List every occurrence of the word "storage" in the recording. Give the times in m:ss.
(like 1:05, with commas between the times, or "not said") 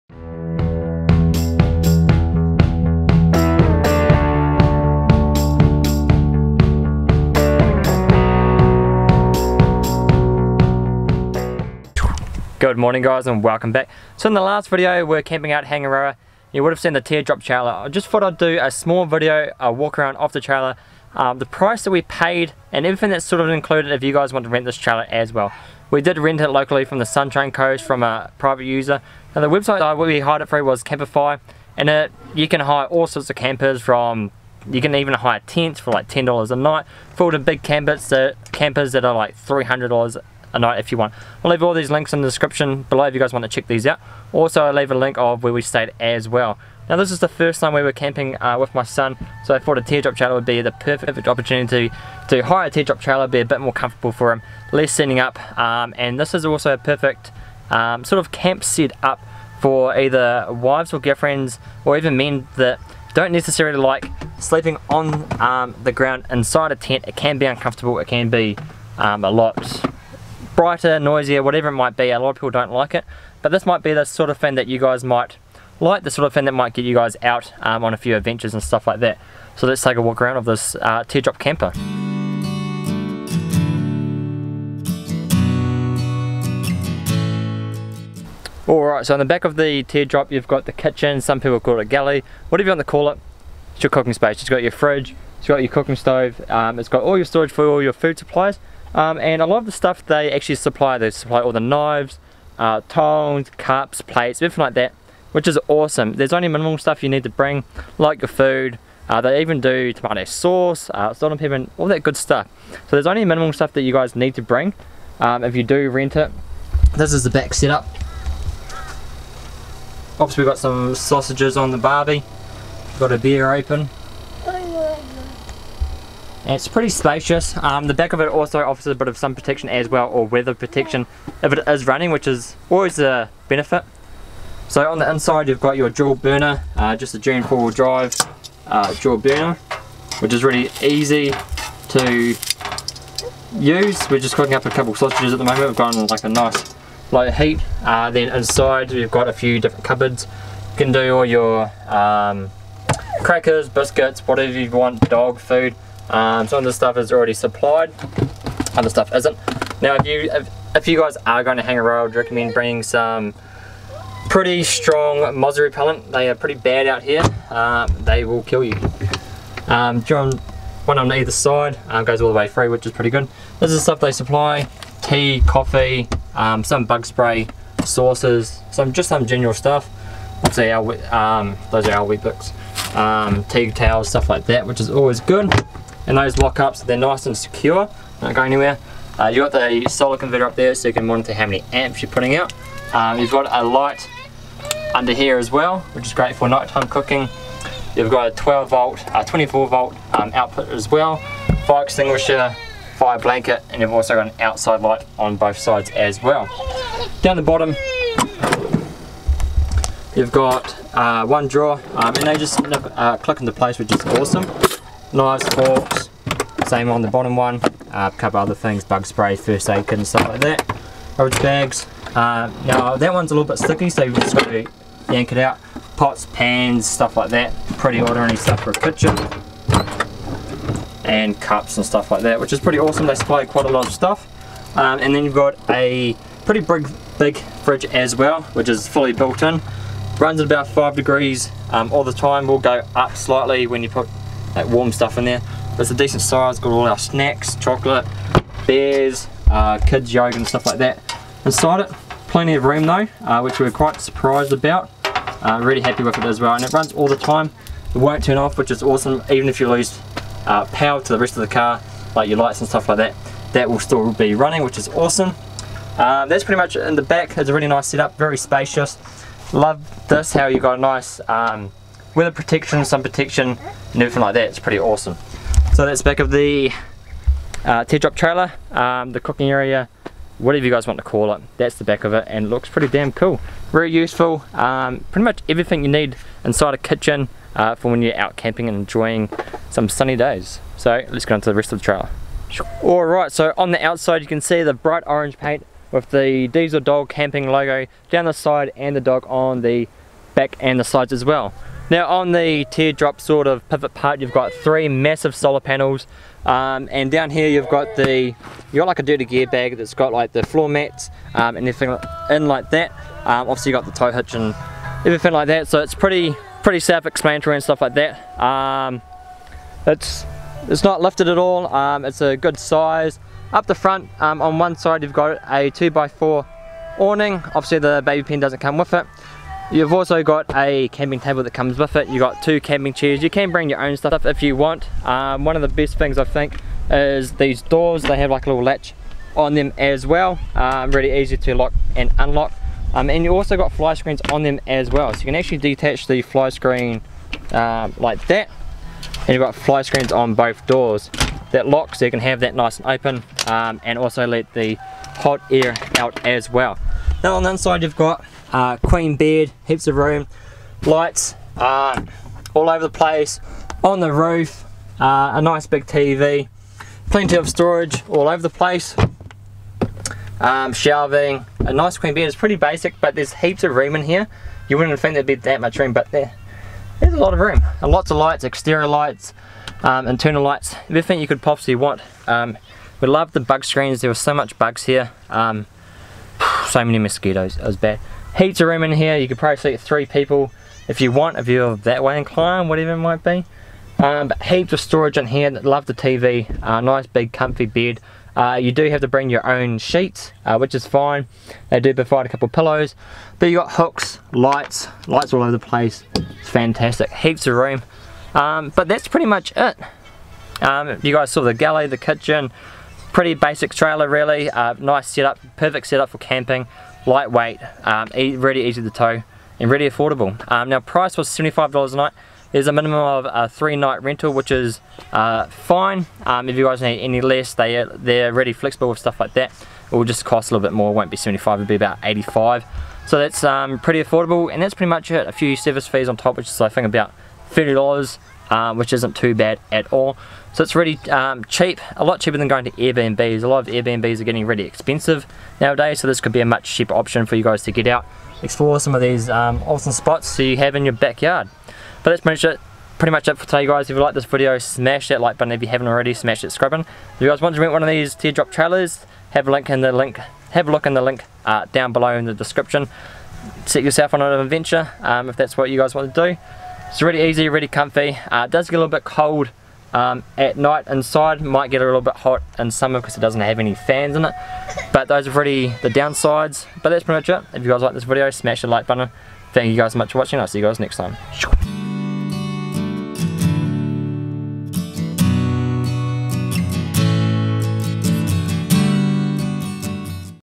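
1:37, 6:07, 6:34.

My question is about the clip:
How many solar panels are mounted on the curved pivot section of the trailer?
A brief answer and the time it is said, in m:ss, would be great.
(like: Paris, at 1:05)
3, at 5:04.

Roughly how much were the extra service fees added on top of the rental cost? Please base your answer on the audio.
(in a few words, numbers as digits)
$30.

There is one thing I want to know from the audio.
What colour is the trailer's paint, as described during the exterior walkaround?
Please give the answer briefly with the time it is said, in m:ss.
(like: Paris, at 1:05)
Bright orange, at 4:54.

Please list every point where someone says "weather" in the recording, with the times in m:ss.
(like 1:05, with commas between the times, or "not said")
2:10, 4:32.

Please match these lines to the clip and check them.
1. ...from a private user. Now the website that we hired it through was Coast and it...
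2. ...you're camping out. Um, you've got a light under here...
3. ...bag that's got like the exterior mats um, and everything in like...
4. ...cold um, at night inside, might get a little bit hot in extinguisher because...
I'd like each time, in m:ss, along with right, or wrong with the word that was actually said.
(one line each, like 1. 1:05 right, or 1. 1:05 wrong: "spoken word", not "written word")
1. 0:27 wrong: "Camplify", not "Coast"
2. 3:12 wrong: "putting", not "camping"
3. 5:09 wrong: "floor", not "exterior"
4. 7:49 wrong: "summer", not "extinguisher".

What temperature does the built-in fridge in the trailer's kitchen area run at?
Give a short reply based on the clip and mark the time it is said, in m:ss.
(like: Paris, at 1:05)
5 degrees, at 4:00.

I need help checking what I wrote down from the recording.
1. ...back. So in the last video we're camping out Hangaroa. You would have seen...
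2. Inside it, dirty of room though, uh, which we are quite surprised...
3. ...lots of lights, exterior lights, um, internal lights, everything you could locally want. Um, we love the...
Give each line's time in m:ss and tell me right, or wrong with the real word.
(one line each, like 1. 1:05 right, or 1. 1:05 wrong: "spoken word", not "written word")
1. 0:13 right
2. 4:11 wrong: "plenty", not "dirty"
3. 6:17 wrong: "possibly", not "locally".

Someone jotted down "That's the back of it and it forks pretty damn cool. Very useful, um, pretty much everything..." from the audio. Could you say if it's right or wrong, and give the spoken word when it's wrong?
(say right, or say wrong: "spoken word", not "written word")
wrong: "looks", not "forks".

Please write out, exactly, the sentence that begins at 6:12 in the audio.
It's pretty basic, but there's heaps of room in here.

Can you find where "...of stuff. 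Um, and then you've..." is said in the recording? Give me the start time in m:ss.
3:53.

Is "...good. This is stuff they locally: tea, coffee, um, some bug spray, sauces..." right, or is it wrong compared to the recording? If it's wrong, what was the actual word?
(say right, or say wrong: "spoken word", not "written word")
wrong: "supply", not "locally".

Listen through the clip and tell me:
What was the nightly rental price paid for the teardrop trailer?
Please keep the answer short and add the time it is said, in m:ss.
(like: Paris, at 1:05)
$75, at 7:01.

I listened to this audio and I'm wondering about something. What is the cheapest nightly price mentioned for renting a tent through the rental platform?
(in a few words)
$10.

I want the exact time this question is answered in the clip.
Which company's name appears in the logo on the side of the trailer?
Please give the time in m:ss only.
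4:56.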